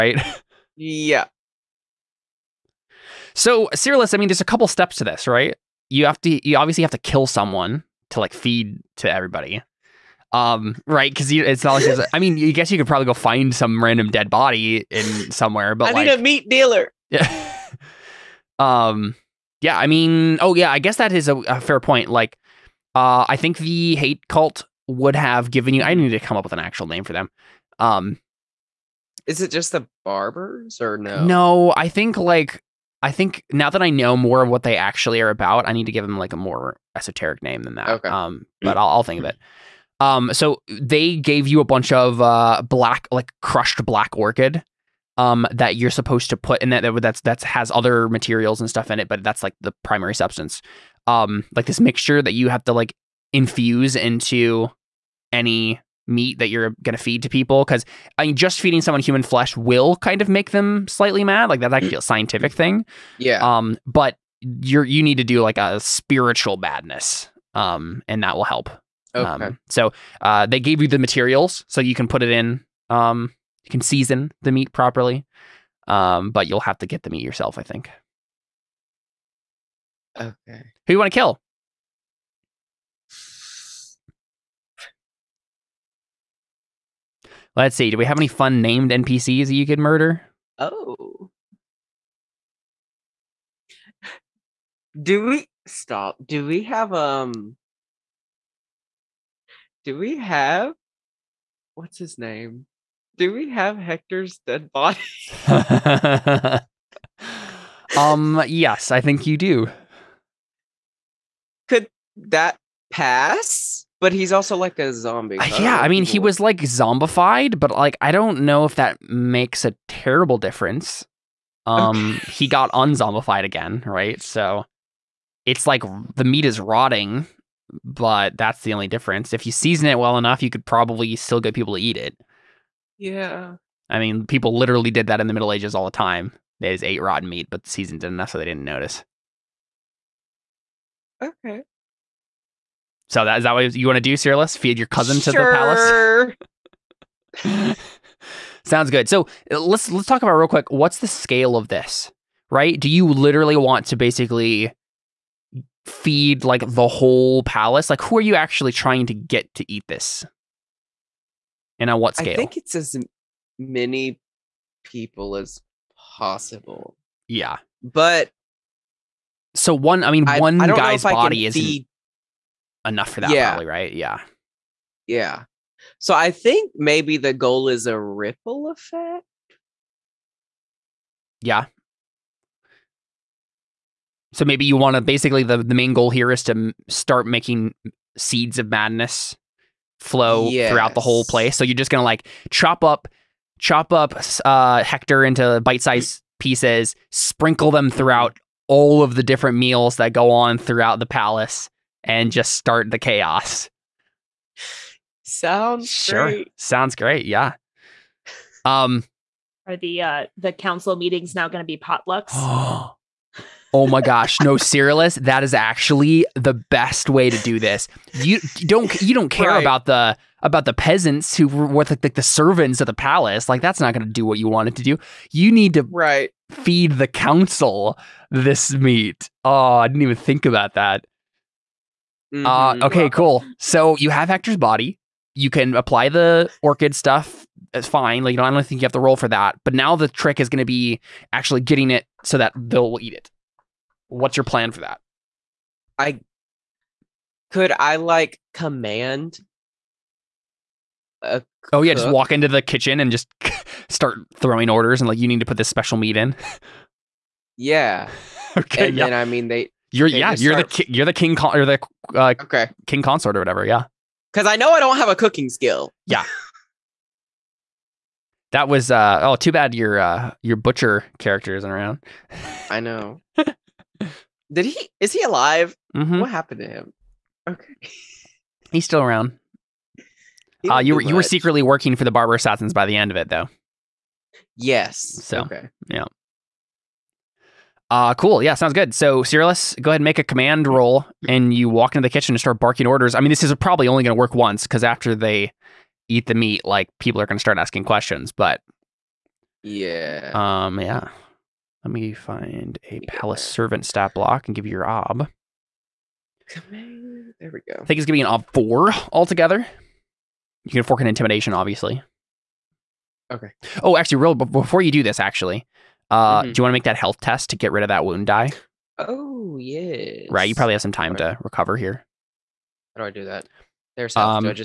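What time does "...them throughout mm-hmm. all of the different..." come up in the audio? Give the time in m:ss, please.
3:17.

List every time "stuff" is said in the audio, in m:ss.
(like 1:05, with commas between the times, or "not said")
0:48, 3:56.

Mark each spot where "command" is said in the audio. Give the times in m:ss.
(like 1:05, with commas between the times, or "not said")
4:08, 4:50.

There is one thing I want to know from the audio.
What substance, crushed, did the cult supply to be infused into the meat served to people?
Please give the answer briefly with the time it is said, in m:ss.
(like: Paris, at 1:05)
black orchid, at 0:43.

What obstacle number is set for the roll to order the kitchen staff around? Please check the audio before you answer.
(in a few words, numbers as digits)
4.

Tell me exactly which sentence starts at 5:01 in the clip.
Let me find a palace servant stat block and give you your ob.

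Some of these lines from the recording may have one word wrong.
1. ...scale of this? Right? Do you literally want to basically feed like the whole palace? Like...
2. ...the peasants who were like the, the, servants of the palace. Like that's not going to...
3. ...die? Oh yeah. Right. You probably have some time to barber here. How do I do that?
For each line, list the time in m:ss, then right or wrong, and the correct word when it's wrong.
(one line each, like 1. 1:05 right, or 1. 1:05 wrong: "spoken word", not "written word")
1. 2:31 right
2. 3:40 right
3. 5:18 wrong: "recover", not "barber".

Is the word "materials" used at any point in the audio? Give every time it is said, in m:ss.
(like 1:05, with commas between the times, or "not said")
0:48, 1:10.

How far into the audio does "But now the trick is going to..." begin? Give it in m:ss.
3:59.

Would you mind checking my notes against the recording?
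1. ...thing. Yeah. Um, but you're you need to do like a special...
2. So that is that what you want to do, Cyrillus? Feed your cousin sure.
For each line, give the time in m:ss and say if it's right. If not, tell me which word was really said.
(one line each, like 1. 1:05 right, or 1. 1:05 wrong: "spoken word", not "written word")
1. 1:02 wrong: "spiritual", not "special"
2. 2:23 right.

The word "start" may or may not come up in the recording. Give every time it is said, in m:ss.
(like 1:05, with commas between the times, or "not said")
3:06, 3:22, 4:13, 4:52, 4:57.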